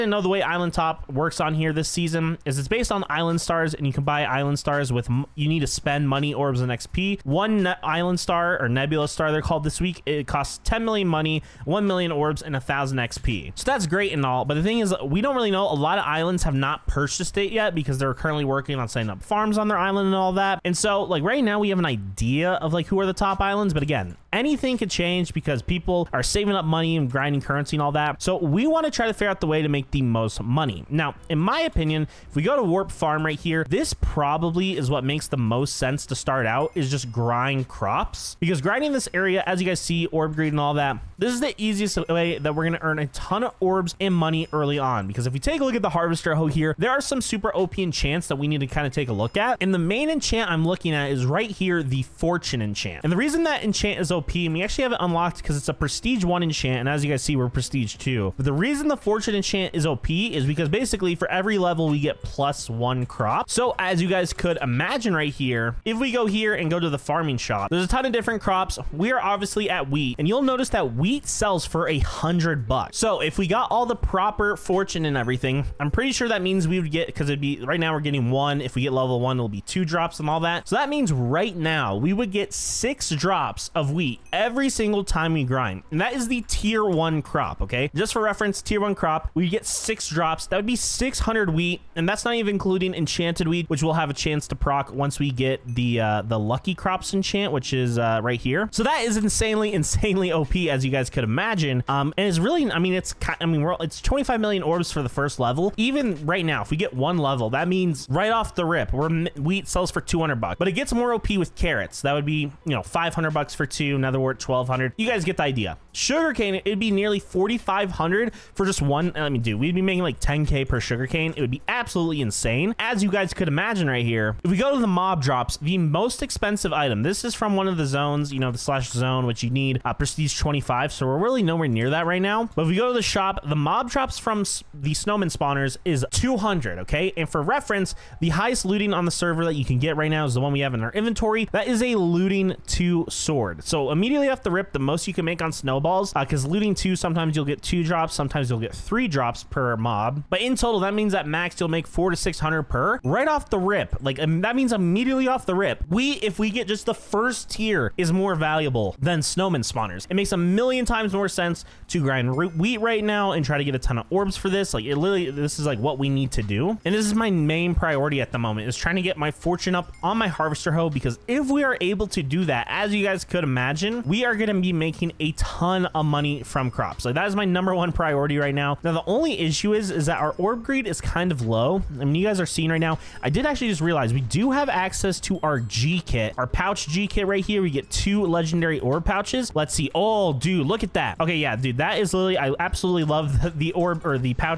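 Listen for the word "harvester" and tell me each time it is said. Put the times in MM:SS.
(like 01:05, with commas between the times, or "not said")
00:45, 02:50.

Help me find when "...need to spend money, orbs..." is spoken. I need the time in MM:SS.
00:05.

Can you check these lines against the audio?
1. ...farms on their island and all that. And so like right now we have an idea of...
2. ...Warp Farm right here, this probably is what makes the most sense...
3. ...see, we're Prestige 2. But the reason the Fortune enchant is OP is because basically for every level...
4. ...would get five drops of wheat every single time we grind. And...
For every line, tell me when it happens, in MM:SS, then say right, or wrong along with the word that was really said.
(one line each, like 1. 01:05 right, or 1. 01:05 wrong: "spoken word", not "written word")
1. 00:19 right
2. 00:32 right
3. 00:57 right
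4. 01:22 wrong: "six", not "five".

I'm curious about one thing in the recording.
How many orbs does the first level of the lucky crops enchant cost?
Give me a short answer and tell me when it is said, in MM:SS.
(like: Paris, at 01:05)
25 million, at 01:44.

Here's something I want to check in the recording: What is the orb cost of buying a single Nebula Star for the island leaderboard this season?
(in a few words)
1 million orbs.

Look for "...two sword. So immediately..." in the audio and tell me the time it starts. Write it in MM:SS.
02:22.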